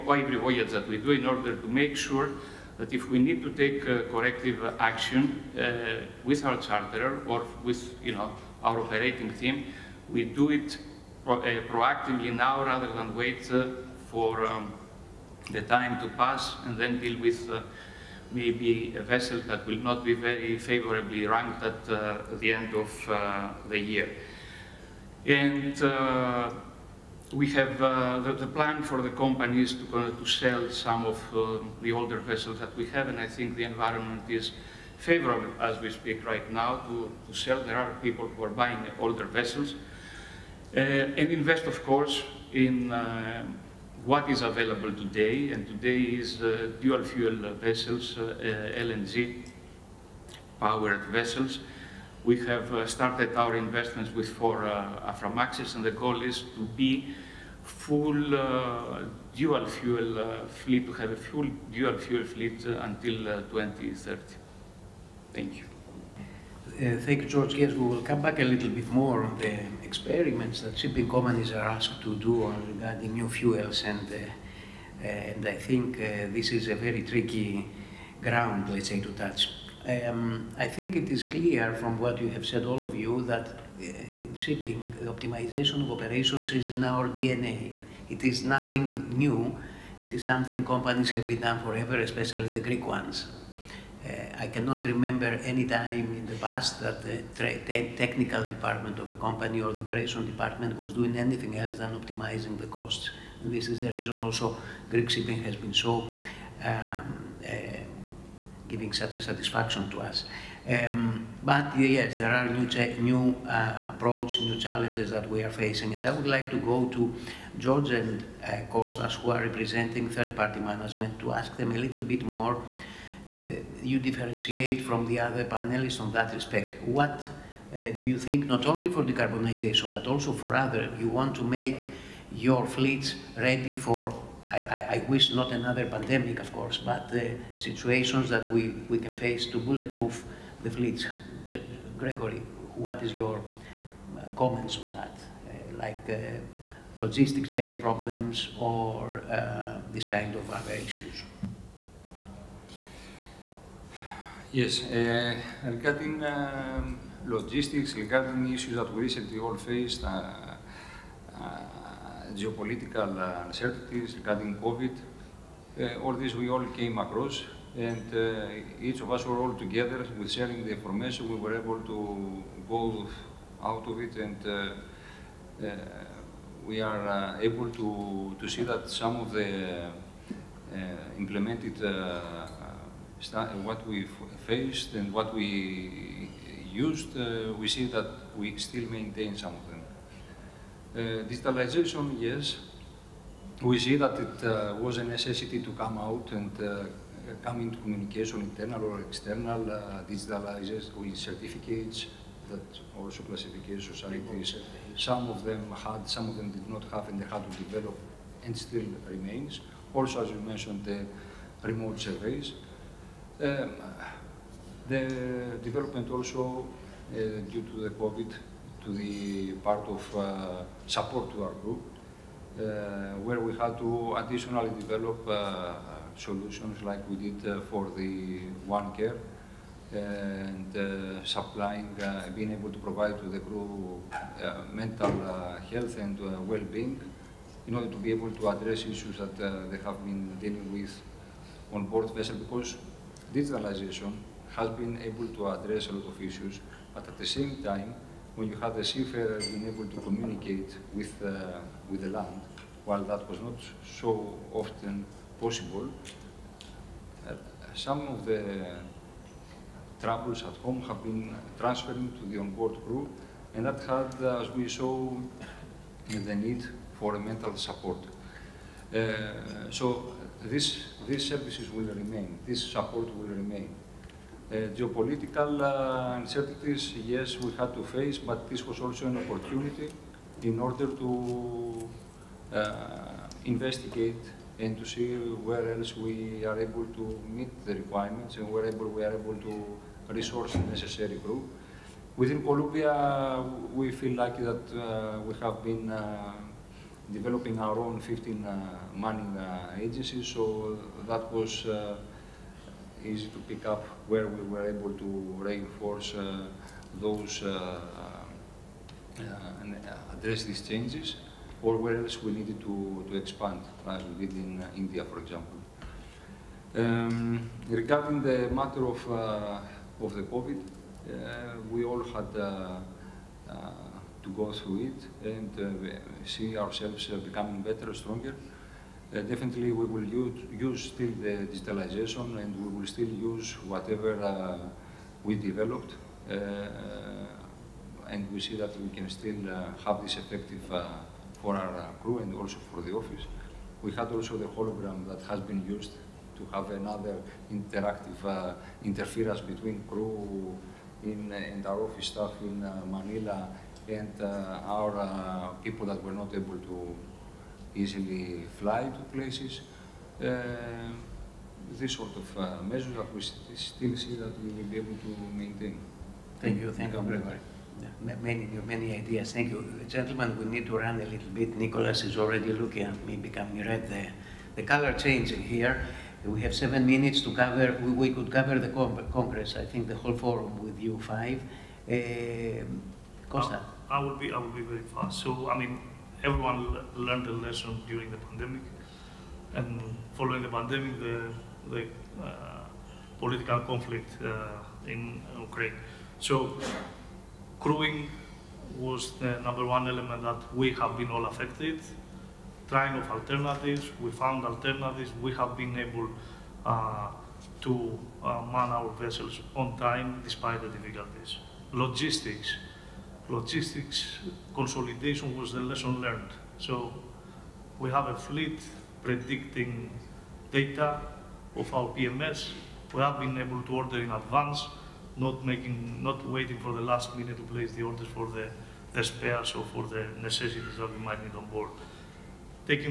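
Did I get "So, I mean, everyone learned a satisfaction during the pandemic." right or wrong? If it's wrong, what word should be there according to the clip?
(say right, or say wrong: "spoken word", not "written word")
wrong: "lesson", not "satisfaction".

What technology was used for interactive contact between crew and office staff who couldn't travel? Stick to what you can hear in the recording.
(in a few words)
hologram.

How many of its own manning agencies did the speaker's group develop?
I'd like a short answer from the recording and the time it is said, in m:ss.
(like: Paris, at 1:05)
15, at 4:58.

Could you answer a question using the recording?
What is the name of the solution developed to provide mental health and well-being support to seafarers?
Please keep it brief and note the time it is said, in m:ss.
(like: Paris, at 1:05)
One Care, at 3:48.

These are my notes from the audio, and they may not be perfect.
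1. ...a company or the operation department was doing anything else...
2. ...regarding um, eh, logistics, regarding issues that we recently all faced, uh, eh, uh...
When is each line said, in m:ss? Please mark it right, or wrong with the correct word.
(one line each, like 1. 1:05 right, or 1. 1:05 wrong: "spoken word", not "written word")
1. 1:39 right
2. 2:35 right.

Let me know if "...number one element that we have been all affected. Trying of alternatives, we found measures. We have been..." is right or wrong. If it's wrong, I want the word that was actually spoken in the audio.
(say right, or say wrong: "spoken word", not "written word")
wrong: "alternatives", not "measures".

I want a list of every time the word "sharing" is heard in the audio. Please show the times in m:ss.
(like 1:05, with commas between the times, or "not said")
2:50.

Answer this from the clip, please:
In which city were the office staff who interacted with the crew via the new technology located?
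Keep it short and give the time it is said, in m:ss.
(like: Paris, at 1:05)
Manila, at 5:52.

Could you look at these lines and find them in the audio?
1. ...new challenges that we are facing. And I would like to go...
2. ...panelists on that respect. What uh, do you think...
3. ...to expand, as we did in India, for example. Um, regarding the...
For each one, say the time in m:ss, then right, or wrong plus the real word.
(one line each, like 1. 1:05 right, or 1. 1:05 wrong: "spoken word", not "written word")
1. 1:54 right
2. 2:05 right
3. 5:13 right.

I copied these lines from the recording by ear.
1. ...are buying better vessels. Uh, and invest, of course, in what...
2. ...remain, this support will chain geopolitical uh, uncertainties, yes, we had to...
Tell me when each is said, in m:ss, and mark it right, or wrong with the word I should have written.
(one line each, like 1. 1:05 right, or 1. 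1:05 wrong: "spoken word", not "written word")
1. 0:38 wrong: "older", not "better"
2. 4:31 wrong: "remain", not "chain".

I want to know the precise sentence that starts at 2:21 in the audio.
Gregory, what is your uh, comments on that, uh, like uh, logistic chain problems or uh, this kind of other issues?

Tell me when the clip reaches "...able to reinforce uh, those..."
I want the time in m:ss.
5:04.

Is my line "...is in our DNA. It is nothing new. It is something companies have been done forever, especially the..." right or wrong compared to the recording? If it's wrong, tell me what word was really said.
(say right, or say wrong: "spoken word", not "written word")
right.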